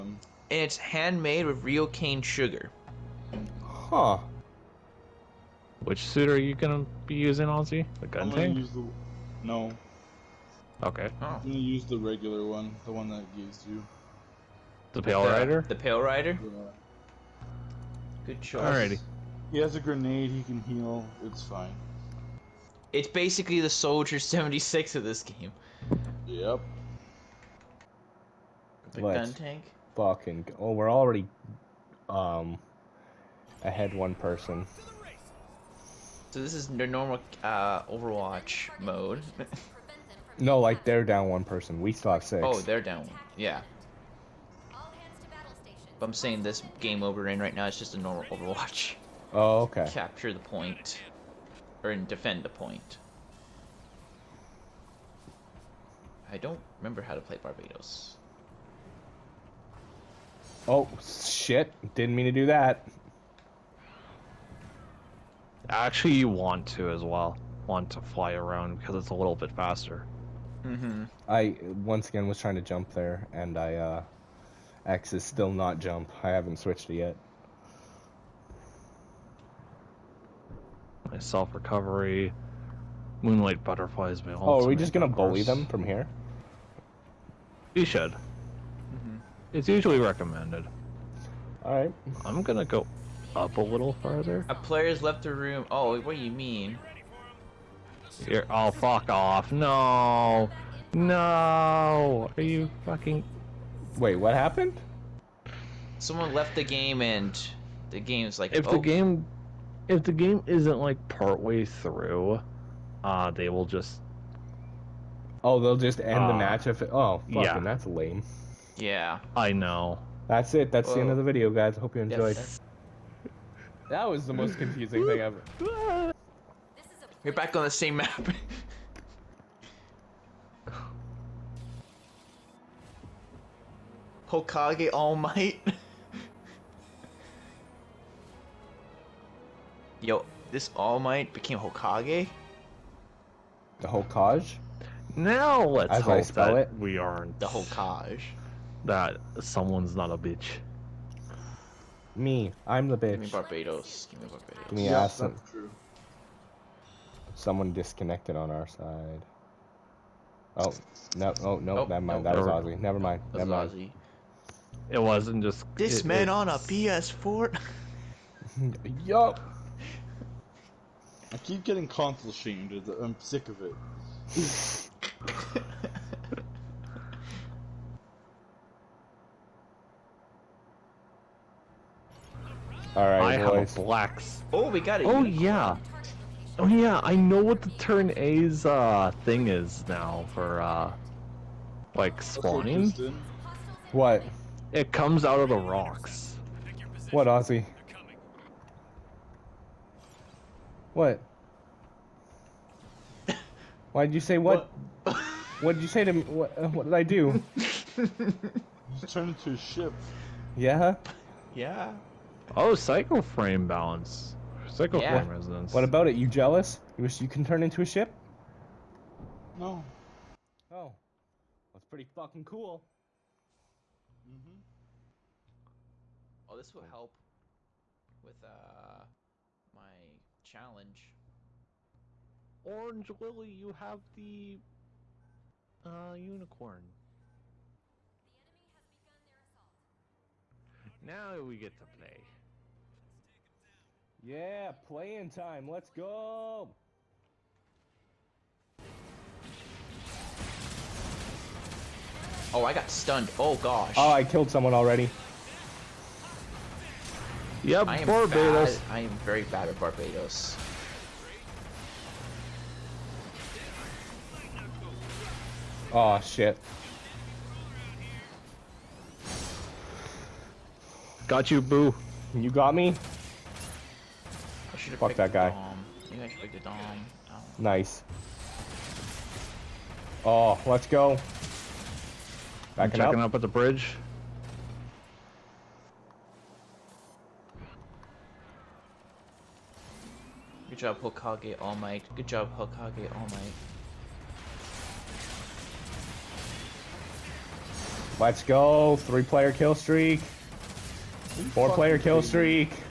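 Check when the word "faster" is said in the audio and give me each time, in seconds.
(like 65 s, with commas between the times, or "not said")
69 s.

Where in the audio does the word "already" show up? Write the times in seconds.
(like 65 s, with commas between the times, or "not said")
30 s, 254 s.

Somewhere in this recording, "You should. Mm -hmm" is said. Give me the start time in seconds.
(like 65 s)
87 s.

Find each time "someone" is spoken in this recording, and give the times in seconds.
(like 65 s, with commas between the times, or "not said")
105 s, 149 s, 157 s, 254 s.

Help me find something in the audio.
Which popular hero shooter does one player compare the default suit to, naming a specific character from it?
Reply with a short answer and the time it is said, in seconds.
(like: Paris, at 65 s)
Soldier 76, at 23 s.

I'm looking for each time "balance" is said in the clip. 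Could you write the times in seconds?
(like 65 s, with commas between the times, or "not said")
213 s.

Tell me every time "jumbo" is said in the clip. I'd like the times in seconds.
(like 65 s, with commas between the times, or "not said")
not said.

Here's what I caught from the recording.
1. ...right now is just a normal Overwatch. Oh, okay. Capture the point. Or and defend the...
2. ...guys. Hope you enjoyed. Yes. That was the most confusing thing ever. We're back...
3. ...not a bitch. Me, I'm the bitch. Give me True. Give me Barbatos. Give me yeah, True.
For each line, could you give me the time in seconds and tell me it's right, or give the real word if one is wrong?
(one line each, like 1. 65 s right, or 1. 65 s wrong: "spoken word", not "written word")
1. 47 s right
2. 121 s right
3. 149 s wrong: "Barbatos", not "True".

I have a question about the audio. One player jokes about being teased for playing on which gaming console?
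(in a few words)
PS4.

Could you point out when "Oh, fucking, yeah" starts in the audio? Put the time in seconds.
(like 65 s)
116 s.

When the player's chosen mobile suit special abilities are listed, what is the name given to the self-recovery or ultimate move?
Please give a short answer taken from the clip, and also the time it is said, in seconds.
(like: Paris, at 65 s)
Moonlight butterflies, at 83 s.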